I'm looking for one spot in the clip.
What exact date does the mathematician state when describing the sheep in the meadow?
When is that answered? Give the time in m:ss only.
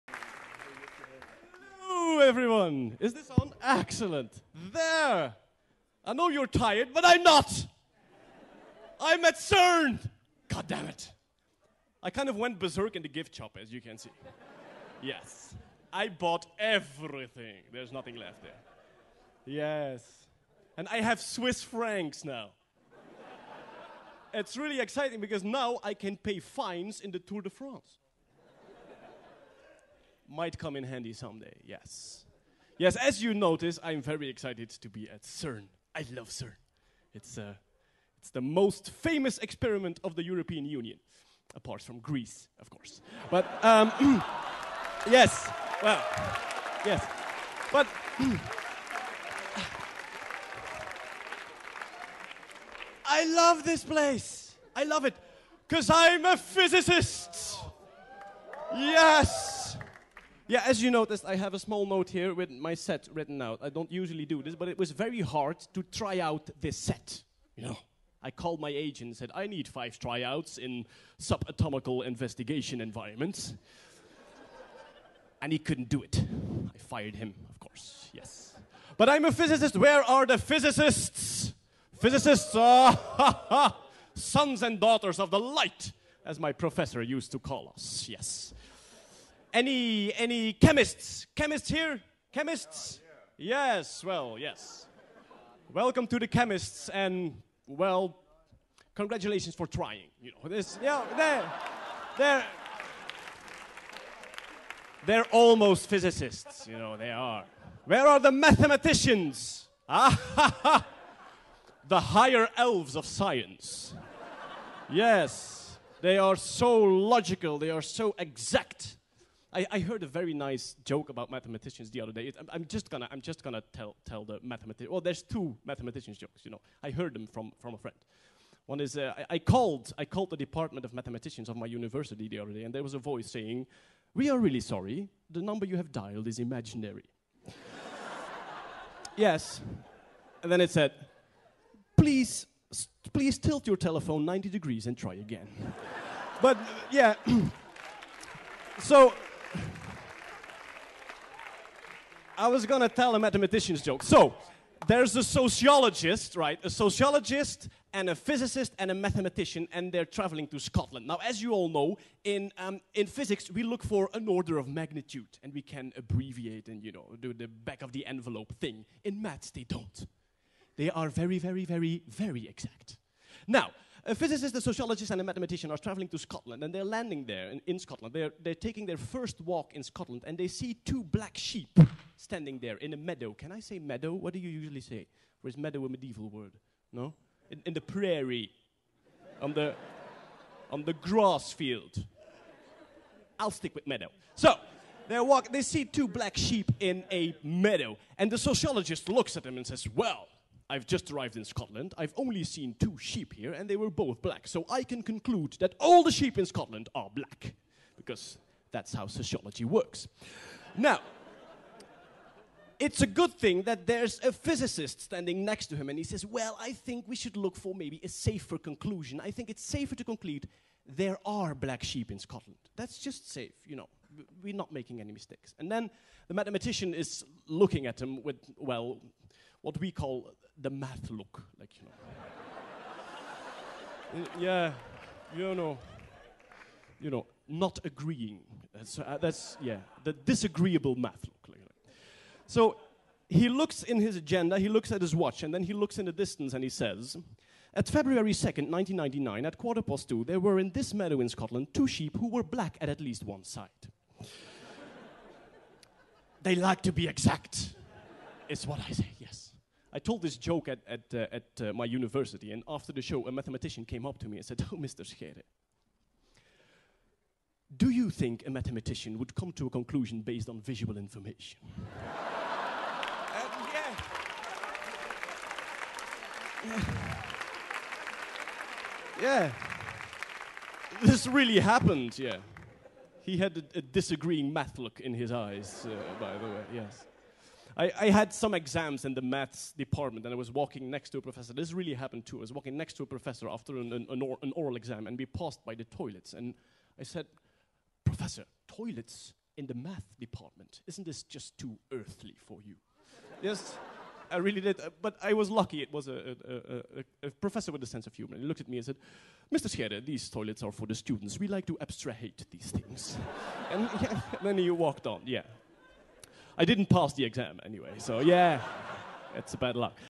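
4:07.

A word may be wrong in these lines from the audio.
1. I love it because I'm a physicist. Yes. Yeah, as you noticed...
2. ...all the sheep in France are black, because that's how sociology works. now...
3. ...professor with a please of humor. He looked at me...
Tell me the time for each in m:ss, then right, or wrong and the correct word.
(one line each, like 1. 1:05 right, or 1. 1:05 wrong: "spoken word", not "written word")
1. 0:54 right
2. 3:25 wrong: "Scotland", not "France"
3. 5:07 wrong: "sense", not "please".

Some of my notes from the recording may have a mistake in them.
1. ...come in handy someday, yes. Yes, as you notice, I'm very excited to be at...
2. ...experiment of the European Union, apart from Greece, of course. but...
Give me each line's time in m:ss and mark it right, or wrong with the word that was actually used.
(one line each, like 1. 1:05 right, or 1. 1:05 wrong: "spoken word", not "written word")
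1. 0:30 right
2. 0:39 right.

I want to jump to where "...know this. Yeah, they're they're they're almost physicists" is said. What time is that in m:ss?
1:40.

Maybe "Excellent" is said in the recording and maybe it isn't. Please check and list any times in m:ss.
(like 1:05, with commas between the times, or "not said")
0:03.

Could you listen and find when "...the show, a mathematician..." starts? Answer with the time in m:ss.
4:22.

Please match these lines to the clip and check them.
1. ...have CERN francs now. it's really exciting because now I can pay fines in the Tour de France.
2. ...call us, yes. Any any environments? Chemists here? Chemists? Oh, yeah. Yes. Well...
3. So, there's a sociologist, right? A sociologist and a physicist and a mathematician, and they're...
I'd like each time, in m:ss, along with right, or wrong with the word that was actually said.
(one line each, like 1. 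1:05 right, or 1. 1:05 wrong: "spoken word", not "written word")
1. 0:21 wrong: "Swiss", not "CERN"
2. 1:27 wrong: "chemists", not "environments"
3. 2:34 right.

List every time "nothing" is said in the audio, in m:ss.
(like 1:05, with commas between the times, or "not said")
0:17.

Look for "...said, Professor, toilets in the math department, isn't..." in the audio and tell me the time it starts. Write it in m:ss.
4:57.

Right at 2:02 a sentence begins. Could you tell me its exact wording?
It, I'm, I'm, just gonna, I'm just gonna tell, tell the mathematician.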